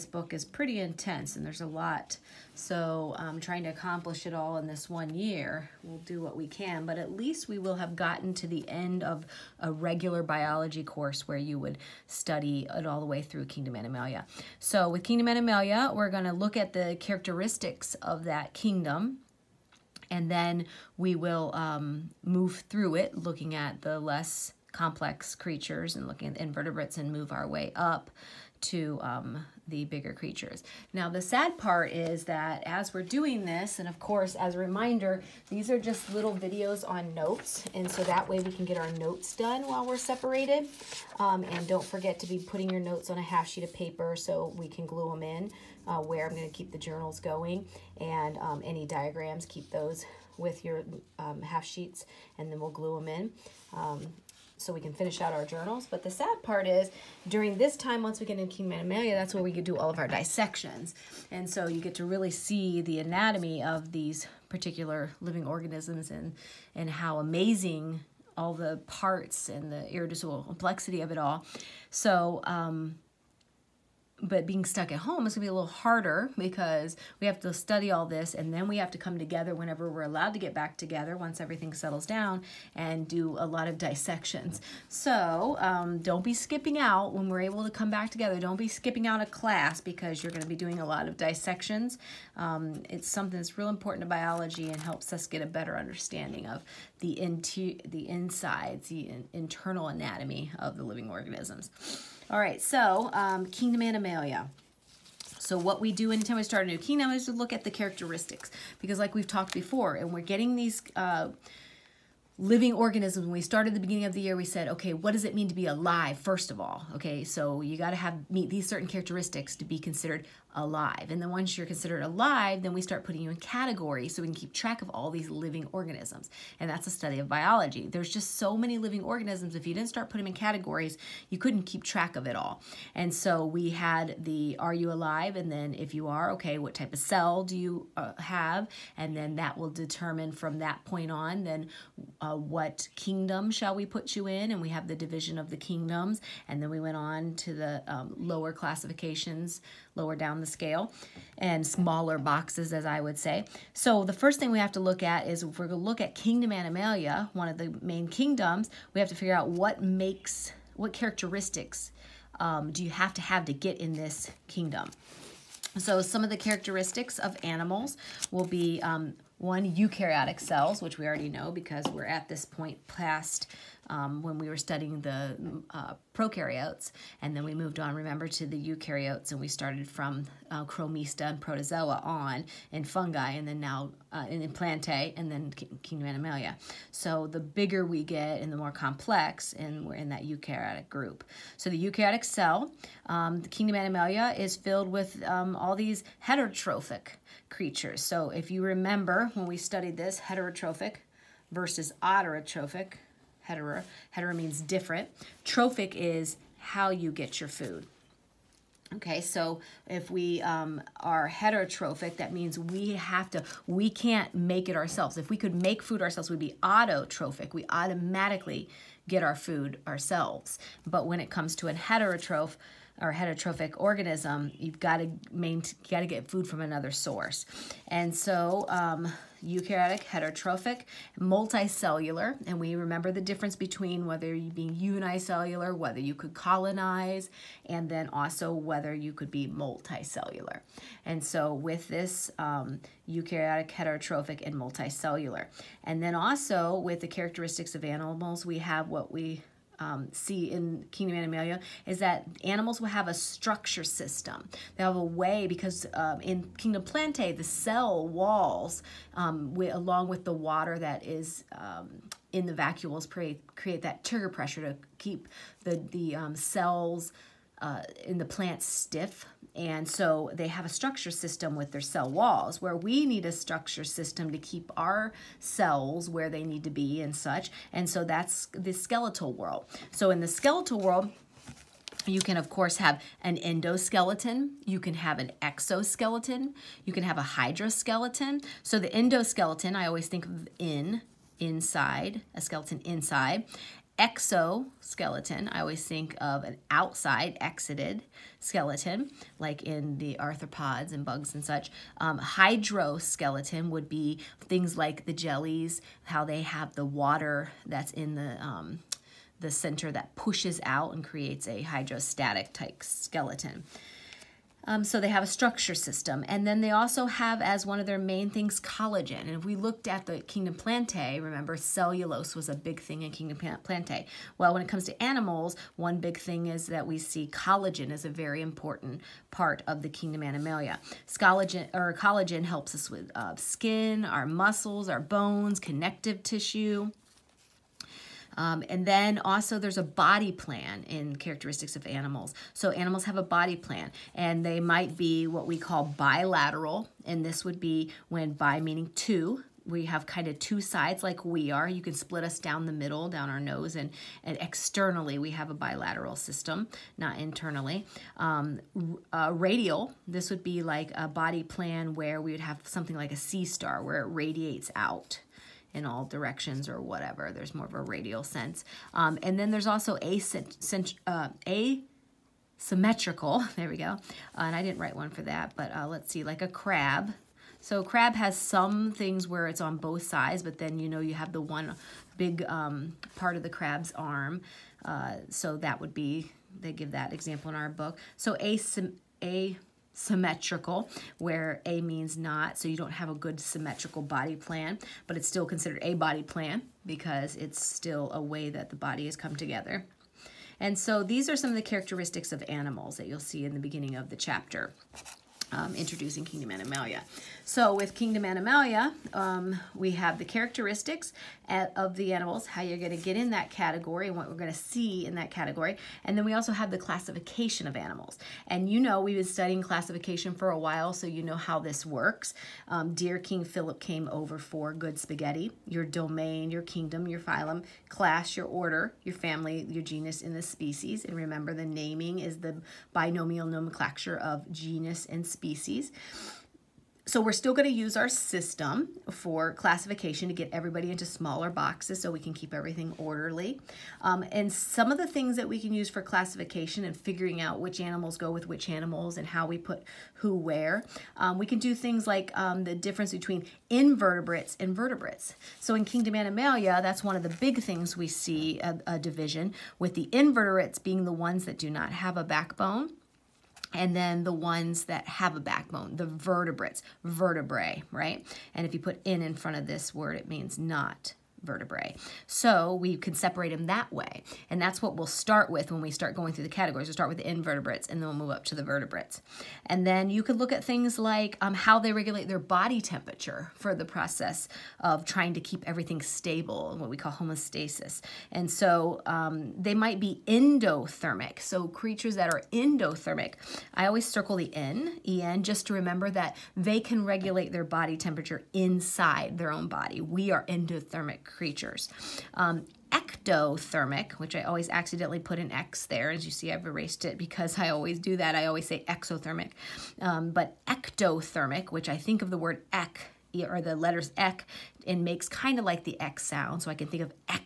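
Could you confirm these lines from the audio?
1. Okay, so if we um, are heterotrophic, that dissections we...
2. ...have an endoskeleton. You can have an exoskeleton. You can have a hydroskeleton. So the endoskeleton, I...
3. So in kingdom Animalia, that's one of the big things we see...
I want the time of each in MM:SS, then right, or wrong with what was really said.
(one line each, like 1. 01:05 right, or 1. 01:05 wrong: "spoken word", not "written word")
1. 03:28 wrong: "means", not "dissections"
2. 04:42 right
3. 07:35 right.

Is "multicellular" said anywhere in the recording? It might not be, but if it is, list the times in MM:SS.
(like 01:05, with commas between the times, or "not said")
03:51, 03:59, 04:04.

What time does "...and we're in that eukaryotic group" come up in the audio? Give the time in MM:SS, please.
03:09.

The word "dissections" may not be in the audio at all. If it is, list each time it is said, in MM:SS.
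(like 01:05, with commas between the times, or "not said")
01:00, 01:23, 01:31.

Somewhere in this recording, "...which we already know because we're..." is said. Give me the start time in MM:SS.
02:50.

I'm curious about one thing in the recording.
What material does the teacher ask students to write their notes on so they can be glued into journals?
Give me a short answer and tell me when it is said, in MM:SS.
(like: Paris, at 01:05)
half sheet of paper, at 00:43.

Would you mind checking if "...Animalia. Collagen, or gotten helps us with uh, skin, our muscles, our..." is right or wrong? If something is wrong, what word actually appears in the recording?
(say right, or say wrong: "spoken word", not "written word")
wrong: "collagen", not "gotten".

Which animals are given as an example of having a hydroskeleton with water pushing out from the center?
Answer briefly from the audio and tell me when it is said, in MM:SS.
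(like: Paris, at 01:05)
jellies, at 05:05.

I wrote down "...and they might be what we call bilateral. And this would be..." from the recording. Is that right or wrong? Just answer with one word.
right.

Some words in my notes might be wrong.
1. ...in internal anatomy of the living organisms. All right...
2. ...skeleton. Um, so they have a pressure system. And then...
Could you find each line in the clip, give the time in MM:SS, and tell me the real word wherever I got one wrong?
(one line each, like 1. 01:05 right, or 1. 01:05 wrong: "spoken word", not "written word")
1. 01:39 right
2. 05:12 wrong: "structure", not "pressure".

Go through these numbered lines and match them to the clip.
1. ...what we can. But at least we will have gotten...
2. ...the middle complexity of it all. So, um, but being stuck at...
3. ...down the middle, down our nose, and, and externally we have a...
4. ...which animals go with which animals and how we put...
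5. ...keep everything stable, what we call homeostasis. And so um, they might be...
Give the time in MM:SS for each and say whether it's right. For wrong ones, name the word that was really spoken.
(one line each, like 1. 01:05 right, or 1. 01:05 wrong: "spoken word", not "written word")
1. 00:06 right
2. 01:09 wrong: "irreducible", not "middle"
3. 05:52 right
4. 07:27 right
5. 08:05 right.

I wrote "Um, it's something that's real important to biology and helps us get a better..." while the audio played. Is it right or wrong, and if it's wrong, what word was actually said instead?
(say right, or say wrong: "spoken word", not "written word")
right.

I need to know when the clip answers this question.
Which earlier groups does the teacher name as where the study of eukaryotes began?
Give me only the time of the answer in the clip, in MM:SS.
03:00.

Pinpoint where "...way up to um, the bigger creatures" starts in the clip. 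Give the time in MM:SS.
00:27.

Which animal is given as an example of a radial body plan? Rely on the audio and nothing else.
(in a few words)
sea star.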